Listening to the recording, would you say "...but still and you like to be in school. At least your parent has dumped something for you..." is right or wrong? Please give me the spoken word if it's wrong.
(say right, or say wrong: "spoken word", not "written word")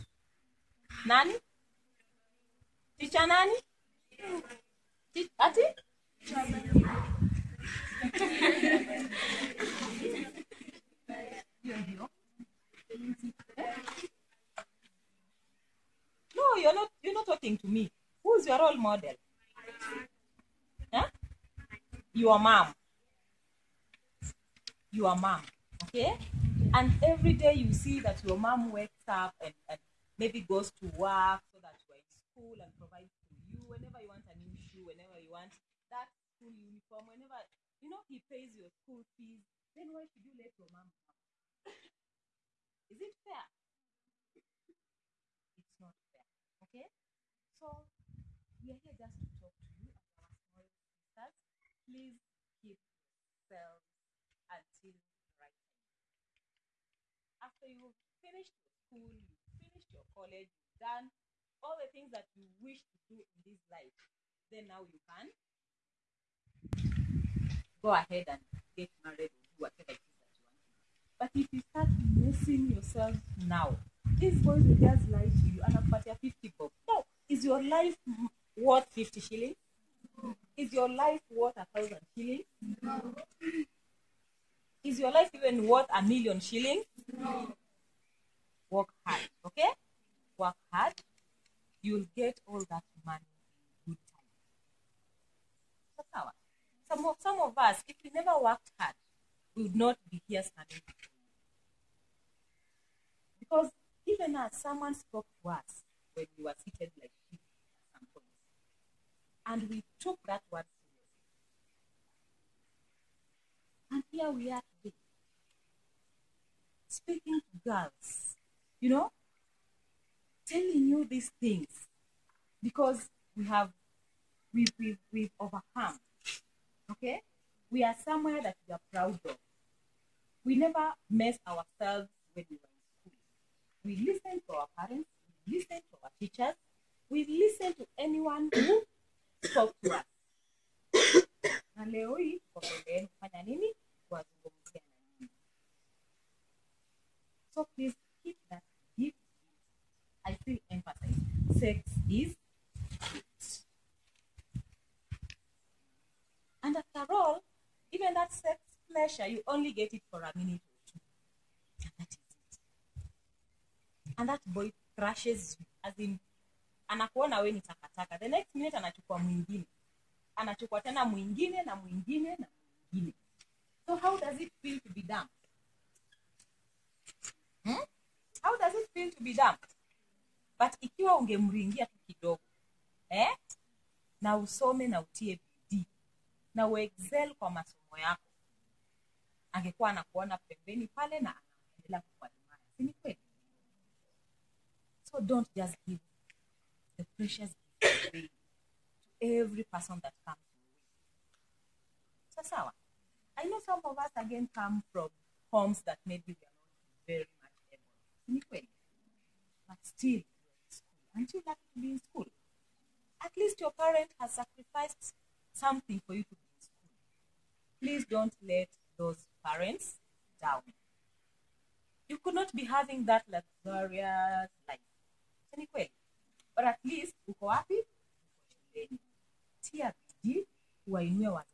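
wrong: "sacrificed", not "dumped".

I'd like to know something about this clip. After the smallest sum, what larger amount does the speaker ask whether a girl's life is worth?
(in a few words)
1000 shillings.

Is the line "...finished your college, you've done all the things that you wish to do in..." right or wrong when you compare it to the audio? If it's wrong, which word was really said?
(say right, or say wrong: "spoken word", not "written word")
right.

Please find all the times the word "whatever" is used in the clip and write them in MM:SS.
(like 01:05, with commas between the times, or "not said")
01:09.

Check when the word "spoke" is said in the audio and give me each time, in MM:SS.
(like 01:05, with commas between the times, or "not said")
01:44, 02:19.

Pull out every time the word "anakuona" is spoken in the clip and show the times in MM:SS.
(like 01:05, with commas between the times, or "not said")
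02:46, 03:09.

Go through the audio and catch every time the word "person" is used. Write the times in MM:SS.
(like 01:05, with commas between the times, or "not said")
03:19.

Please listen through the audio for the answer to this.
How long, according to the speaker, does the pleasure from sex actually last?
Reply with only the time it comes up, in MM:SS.
02:40.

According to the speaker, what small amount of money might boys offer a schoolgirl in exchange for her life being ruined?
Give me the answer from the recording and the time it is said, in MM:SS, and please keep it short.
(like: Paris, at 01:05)
50 bob, at 01:16.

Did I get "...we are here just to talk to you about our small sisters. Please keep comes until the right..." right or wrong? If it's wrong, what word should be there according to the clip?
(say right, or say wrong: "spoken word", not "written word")
wrong: "yourselves", not "comes".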